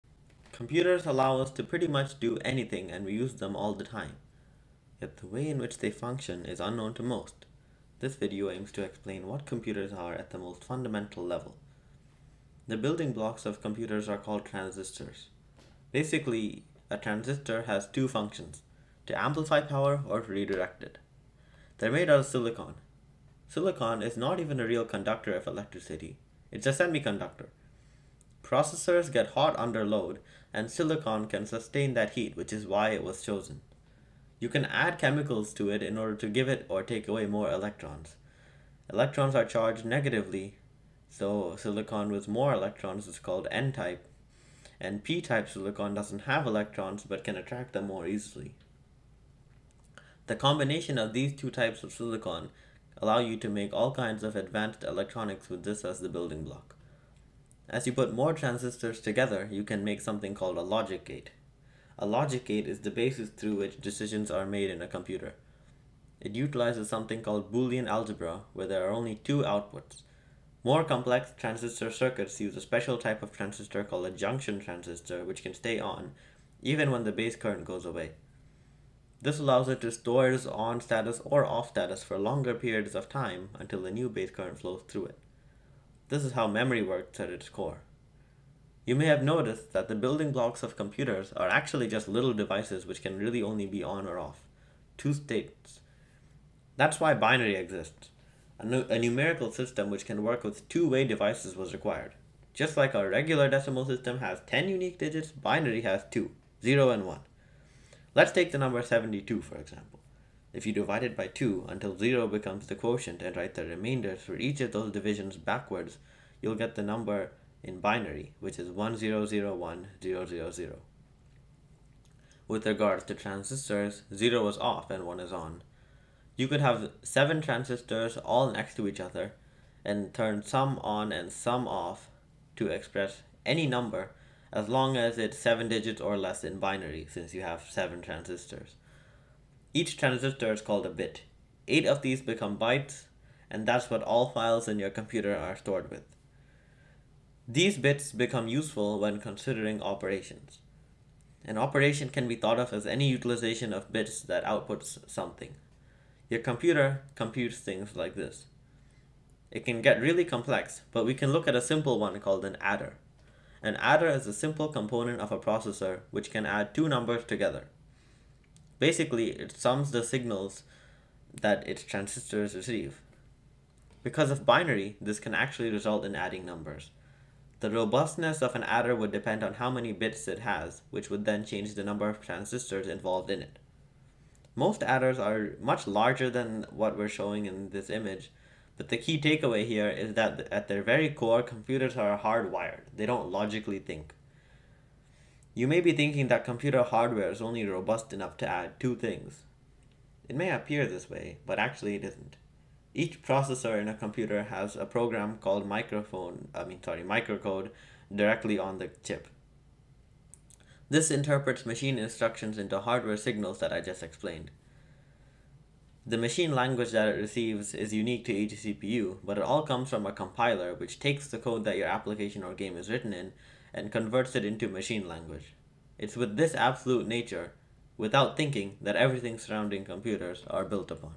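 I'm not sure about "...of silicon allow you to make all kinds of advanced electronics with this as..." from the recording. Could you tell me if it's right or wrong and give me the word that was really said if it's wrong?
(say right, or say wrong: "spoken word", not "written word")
right.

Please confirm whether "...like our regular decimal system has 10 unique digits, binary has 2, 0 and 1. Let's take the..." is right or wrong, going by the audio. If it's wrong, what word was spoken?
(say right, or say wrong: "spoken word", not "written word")
right.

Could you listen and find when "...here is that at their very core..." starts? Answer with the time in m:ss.
3:09.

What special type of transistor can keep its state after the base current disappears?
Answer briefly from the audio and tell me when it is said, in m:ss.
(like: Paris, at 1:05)
Junction transistor, at 1:14.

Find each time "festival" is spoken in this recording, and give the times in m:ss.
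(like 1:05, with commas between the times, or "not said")
not said.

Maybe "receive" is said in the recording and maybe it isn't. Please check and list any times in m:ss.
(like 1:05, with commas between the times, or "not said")
2:52, 3:37.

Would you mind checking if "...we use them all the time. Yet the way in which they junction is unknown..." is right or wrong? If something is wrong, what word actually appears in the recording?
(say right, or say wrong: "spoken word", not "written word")
wrong: "function", not "junction".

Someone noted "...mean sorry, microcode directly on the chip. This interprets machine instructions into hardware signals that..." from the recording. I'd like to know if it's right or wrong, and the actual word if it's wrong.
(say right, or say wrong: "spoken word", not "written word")
right.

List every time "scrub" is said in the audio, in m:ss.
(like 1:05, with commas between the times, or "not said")
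not said.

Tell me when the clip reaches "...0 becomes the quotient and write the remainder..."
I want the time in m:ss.
1:51.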